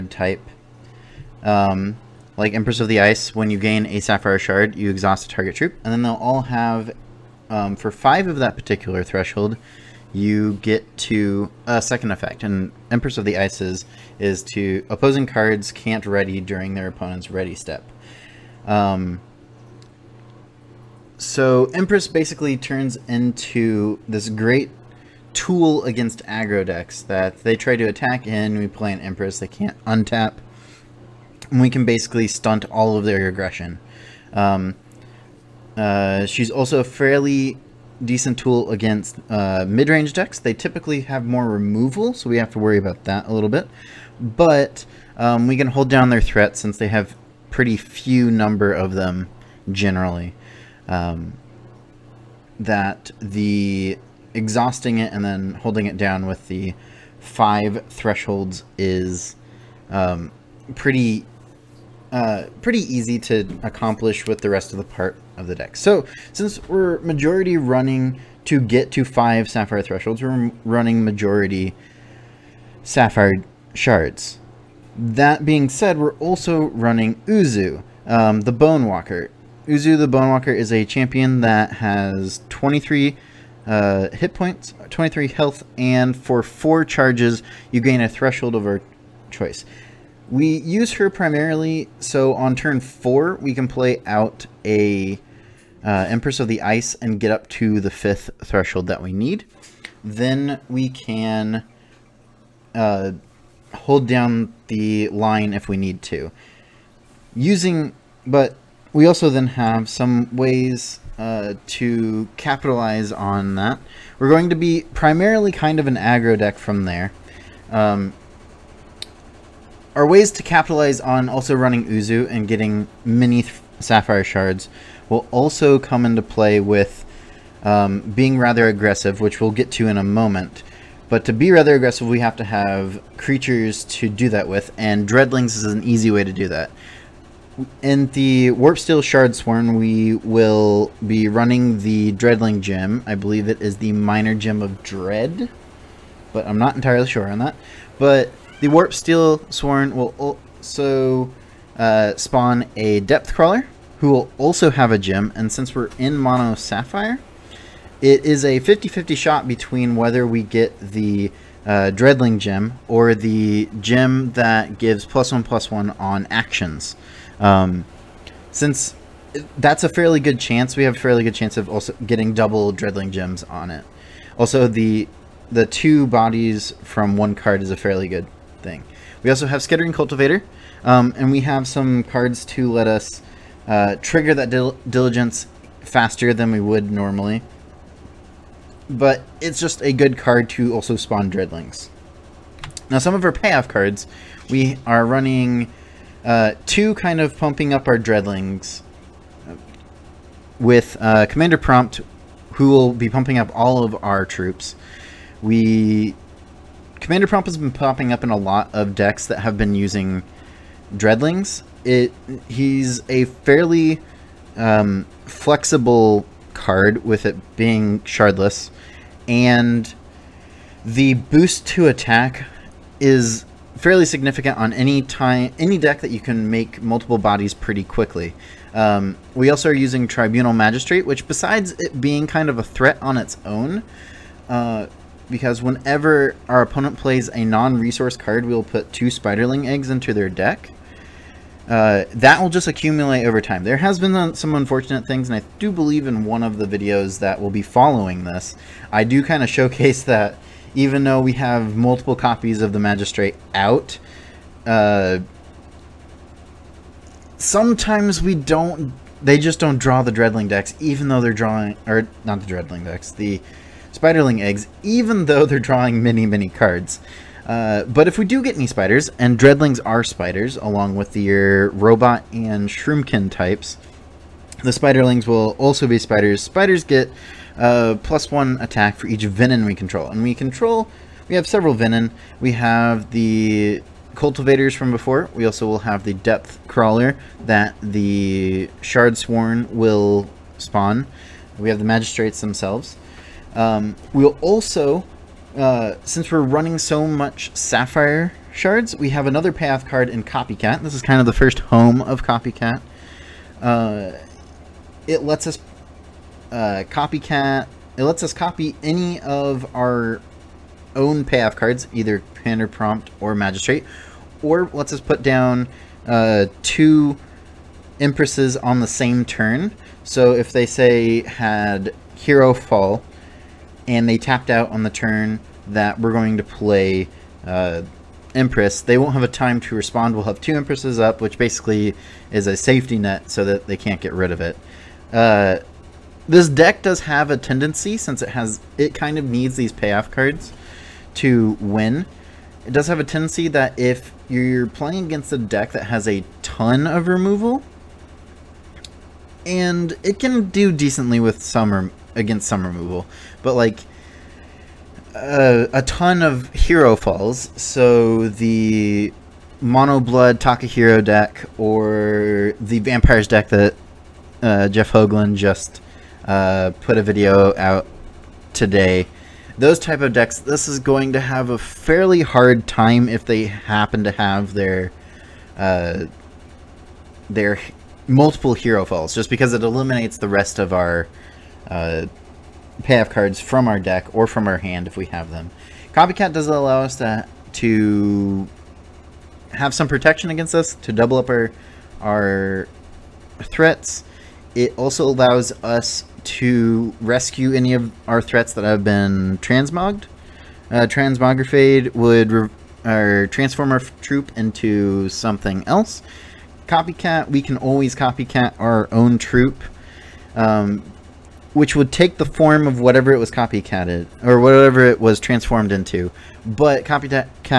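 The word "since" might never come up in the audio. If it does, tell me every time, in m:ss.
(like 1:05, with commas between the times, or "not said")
0:46, 1:06, 2:35, 2:48, 4:56, 5:37.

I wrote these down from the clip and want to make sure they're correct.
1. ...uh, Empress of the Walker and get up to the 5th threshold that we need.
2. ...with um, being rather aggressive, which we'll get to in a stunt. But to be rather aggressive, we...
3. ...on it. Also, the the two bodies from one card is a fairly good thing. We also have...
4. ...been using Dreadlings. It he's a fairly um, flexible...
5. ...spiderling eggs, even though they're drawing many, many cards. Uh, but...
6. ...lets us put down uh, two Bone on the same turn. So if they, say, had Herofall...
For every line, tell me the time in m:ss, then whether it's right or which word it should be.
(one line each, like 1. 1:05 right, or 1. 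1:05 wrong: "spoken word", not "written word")
1. 1:35 wrong: "Ice", not "Walker"
2. 2:06 wrong: "moment", not "stunt"
3. 2:53 right
4. 3:29 right
5. 4:23 right
6. 5:14 wrong: "Empresses", not "Bone".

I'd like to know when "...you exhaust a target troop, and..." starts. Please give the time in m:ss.
0:04.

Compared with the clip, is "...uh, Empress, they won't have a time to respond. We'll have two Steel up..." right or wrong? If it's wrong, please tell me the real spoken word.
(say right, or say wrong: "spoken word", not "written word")
wrong: "Empresses", not "Steel".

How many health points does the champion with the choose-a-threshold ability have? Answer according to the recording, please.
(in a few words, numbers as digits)
23.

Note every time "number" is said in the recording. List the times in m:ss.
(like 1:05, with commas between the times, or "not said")
0:48.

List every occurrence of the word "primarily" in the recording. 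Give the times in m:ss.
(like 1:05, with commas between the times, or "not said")
1:31, 1:54.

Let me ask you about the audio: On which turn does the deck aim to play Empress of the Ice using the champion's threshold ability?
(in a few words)
4.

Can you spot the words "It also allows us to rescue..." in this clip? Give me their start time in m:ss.
6:34.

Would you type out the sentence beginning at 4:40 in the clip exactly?
And we control, we have several venom.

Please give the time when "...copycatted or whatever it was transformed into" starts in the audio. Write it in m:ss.
6:53.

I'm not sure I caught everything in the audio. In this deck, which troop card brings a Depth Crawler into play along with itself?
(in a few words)
Warpsteel Shardsworn.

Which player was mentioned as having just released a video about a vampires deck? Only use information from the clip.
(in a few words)
Jeff Hoagland.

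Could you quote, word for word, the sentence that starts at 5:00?
This is kind of the first home of Copycat.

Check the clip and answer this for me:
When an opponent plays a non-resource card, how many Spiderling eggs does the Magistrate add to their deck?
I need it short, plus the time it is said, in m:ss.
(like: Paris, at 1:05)
2, at 3:58.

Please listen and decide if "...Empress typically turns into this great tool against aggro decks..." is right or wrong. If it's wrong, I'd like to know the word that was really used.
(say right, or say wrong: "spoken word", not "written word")
wrong: "basically", not "typically".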